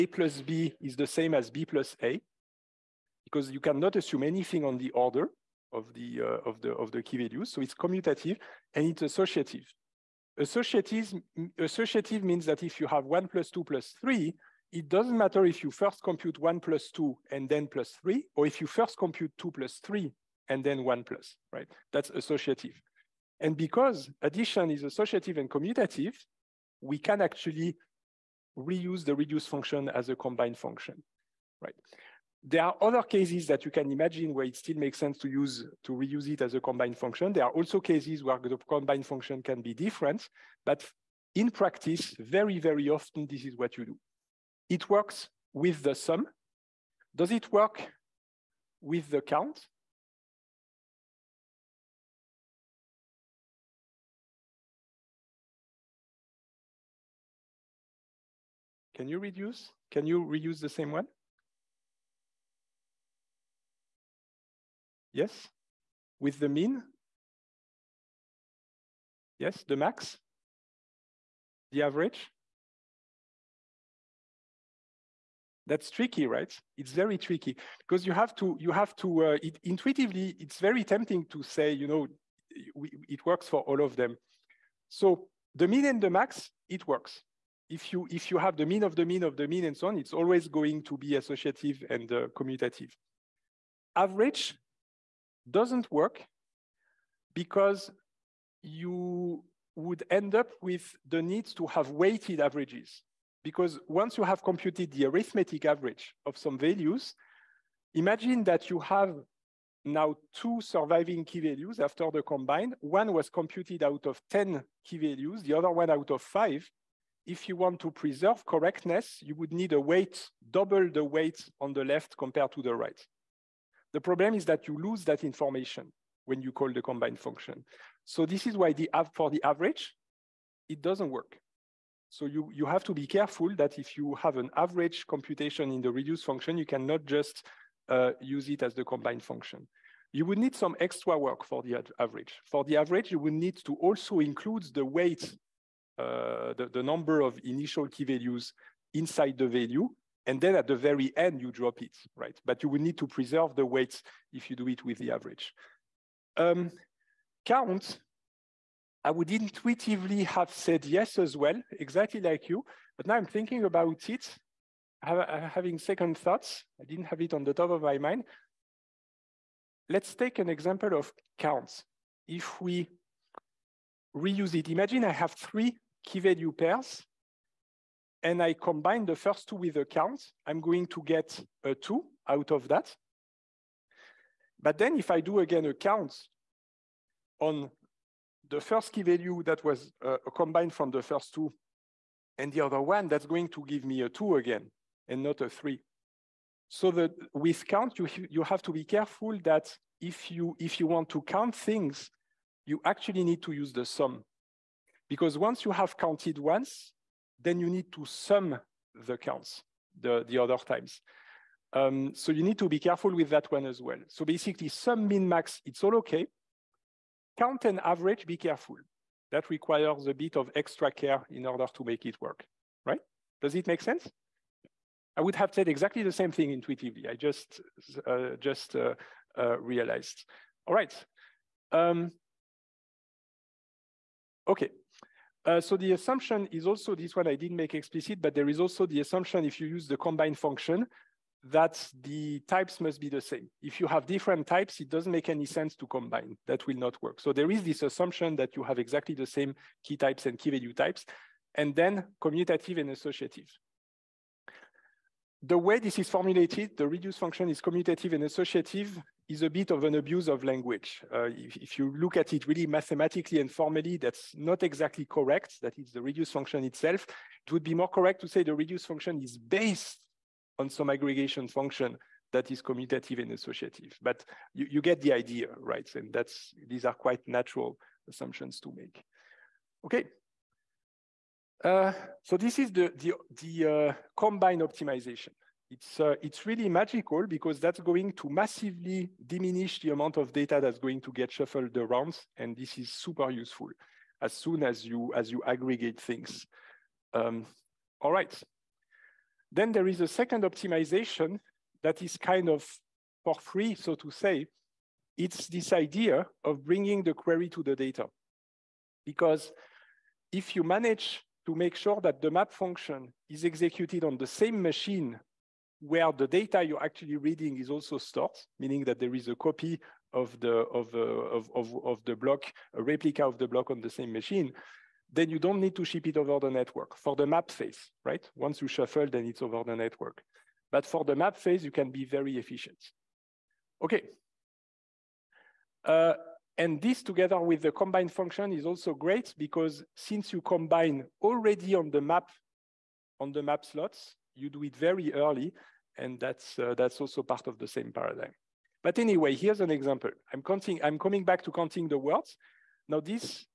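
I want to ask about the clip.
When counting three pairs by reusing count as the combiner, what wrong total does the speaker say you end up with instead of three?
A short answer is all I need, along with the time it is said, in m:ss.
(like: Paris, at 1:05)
2, at 3:14.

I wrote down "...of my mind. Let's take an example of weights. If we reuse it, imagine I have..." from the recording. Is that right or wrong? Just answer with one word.
wrong.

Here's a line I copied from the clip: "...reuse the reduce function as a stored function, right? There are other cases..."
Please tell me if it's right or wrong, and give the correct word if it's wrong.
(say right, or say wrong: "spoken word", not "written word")
wrong: "combined", not "stored".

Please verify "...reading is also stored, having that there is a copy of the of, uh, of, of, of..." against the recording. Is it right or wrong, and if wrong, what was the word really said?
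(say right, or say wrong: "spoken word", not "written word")
wrong: "meaning", not "having".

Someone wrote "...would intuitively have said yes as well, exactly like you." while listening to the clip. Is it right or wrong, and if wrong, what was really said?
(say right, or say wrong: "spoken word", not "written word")
right.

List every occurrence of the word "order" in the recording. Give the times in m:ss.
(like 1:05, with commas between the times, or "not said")
0:04, 3:41.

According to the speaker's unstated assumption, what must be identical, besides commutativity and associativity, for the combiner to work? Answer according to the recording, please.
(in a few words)
the types.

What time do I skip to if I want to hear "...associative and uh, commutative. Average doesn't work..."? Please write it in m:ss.
1:31.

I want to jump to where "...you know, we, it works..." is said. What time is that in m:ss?
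1:21.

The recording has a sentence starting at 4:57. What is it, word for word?
Um, all right, then there is a second optimization that is kind of for free, so to say.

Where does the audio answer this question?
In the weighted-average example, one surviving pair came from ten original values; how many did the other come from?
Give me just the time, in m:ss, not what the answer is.
1:56.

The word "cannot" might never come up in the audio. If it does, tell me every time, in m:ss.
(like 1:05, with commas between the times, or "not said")
0:03, 2:16.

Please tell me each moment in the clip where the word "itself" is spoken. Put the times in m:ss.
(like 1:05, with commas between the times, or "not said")
4:26.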